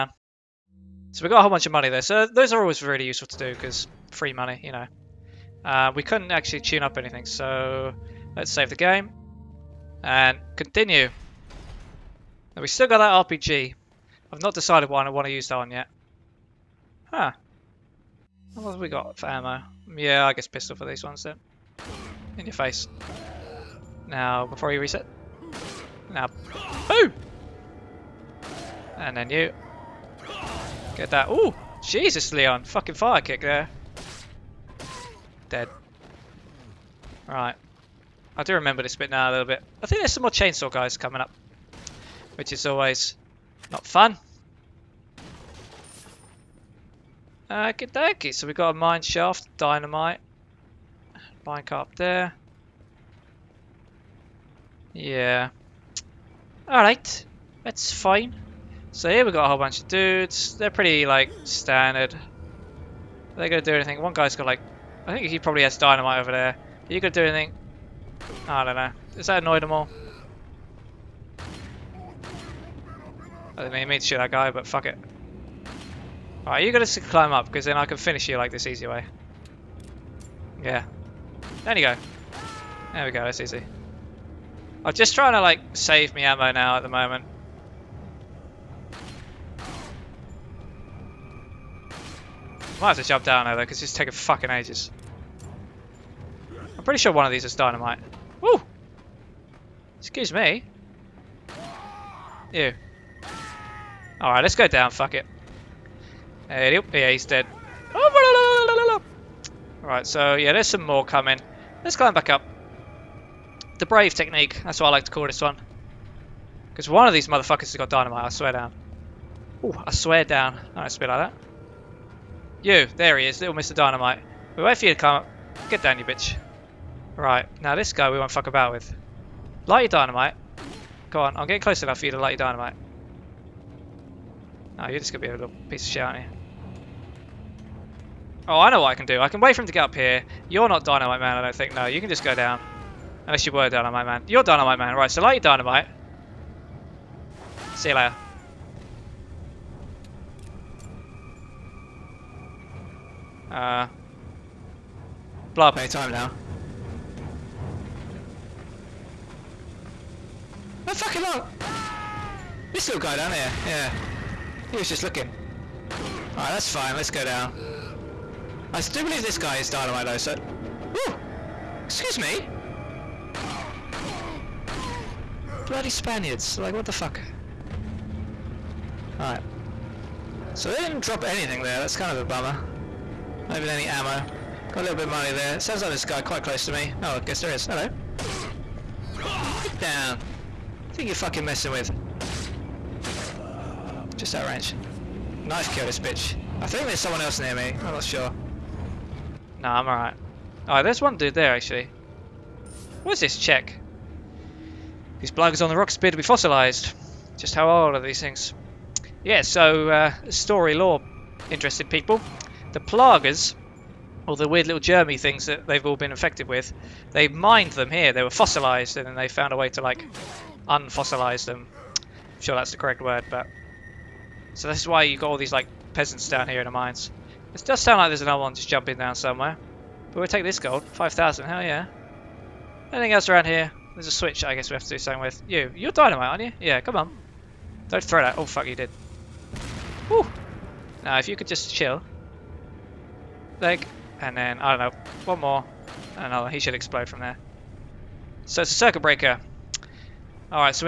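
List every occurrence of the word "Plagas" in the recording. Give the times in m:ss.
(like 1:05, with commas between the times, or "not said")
3:25, 3:32.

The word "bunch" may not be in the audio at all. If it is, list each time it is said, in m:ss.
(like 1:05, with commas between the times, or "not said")
0:01, 0:59.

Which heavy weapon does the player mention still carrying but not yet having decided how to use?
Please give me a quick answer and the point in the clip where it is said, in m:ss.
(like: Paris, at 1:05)
RPG, at 0:13.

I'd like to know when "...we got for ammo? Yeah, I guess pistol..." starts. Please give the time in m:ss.
0:18.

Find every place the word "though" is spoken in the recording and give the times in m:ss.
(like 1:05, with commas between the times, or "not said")
1:33, 2:50.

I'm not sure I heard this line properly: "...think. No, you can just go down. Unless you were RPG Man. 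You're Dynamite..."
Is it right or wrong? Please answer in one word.
wrong.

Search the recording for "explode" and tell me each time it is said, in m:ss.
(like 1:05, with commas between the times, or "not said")
4:06.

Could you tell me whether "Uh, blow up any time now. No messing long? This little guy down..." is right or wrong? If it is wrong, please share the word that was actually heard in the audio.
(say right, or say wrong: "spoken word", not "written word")
wrong: "fucking", not "messing".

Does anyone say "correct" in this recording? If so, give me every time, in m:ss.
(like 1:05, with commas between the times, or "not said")
3:42.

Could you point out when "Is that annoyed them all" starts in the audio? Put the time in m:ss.
1:09.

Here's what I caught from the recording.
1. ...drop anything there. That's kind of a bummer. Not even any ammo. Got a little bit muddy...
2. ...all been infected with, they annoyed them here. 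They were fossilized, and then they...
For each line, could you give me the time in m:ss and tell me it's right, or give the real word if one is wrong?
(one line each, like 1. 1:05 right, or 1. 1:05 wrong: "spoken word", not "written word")
1. 3:01 right
2. 3:35 wrong: "mined", not "annoyed".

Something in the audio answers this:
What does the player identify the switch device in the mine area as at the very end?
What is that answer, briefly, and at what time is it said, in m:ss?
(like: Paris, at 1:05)
circuit breaker, at 4:08.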